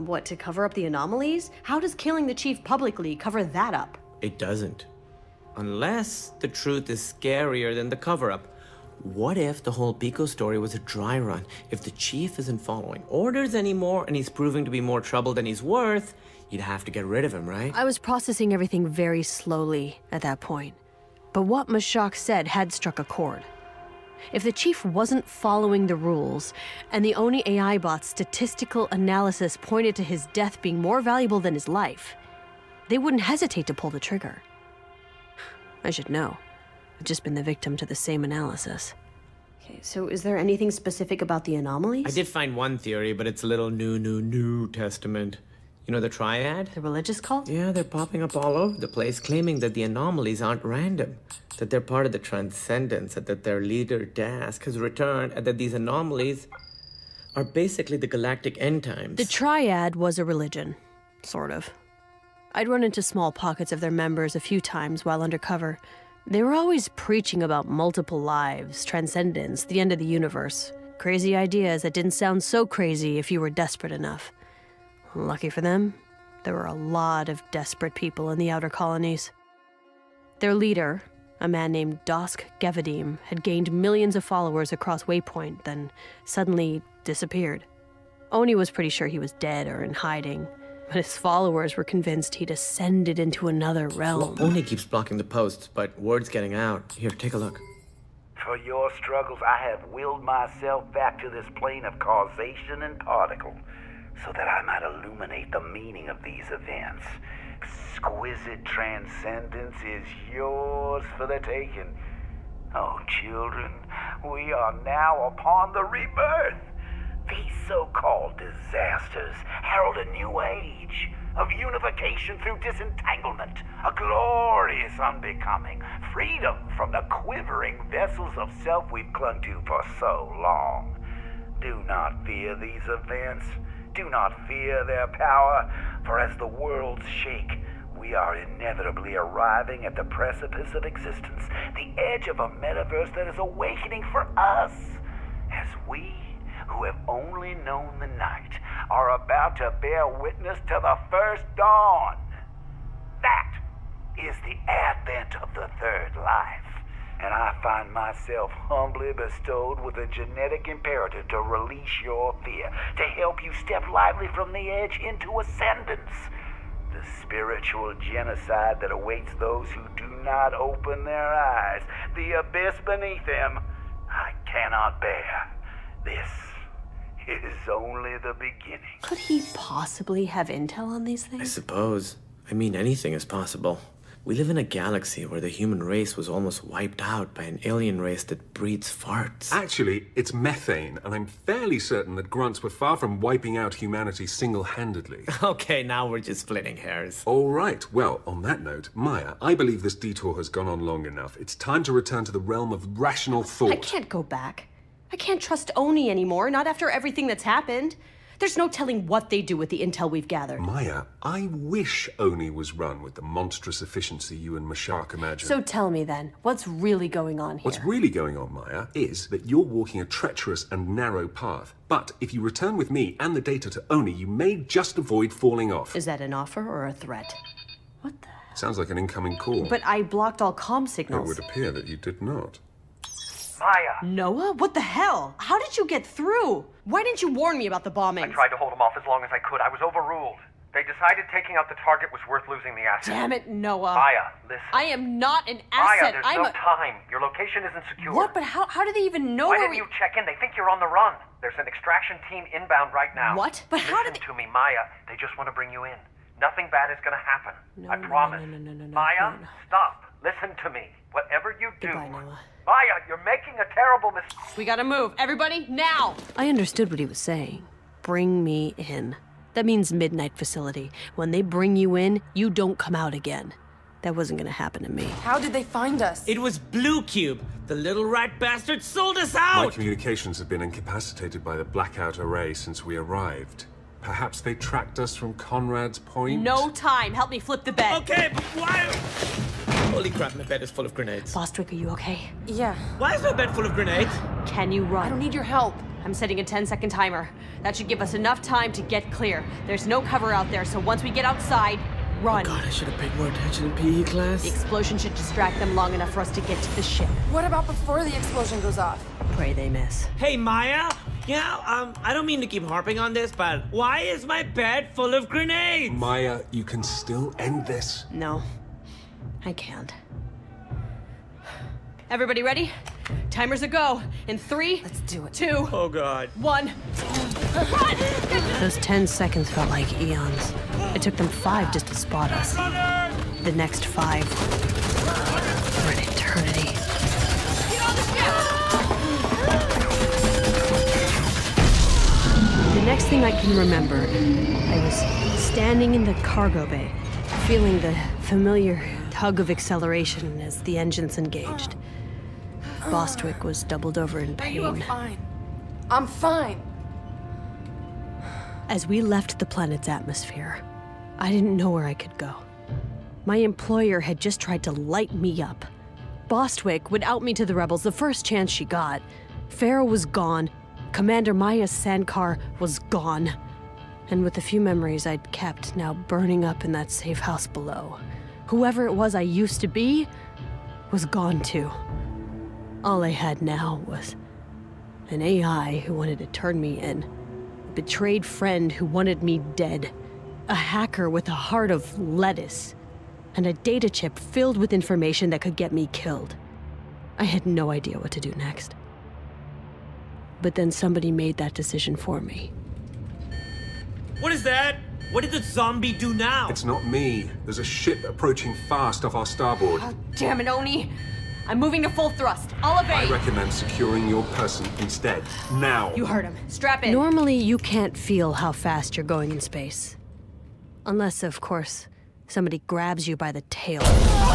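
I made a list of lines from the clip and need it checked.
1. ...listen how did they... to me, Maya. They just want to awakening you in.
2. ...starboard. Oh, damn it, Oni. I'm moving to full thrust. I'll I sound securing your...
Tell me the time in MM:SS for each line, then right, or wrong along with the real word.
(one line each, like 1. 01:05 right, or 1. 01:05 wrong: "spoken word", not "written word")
1. 04:13 wrong: "bring", not "awakening"
2. 06:49 wrong: "recommend", not "sound".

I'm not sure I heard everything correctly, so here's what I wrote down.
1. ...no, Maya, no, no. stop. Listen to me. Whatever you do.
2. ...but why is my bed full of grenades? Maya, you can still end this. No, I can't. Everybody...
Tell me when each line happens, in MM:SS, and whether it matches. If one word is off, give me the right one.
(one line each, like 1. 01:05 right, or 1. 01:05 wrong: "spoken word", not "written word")
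1. 04:18 right
2. 05:13 right.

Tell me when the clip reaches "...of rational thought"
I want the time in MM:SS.
03:22.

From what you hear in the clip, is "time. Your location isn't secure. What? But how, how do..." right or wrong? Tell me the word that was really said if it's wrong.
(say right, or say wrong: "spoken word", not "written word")
right.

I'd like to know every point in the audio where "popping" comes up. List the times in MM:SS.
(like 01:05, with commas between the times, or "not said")
00:47.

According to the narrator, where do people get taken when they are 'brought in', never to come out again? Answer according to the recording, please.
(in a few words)
Midnight facility.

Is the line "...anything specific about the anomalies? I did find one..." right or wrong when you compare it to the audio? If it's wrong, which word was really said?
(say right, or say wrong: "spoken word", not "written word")
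right.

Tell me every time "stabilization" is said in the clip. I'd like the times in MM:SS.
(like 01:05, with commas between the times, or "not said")
not said.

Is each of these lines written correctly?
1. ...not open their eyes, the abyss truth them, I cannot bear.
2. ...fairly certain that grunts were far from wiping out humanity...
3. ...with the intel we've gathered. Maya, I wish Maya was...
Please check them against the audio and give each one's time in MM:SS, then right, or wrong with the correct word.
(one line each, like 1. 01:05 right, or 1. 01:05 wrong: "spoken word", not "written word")
1. 02:50 wrong: "beneath", not "truth"
2. 03:11 right
3. 03:29 wrong: "Oni", not "Maya".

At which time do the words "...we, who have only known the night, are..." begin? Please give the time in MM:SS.
02:25.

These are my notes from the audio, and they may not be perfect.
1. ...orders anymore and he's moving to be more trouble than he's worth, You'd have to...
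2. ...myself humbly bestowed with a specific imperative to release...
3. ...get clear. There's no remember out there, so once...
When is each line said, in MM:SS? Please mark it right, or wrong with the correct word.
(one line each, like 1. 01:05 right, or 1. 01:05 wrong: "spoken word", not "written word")
1. 00:13 wrong: "proving", not "moving"
2. 02:37 wrong: "genetic", not "specific"
3. 04:58 wrong: "cover", not "remember".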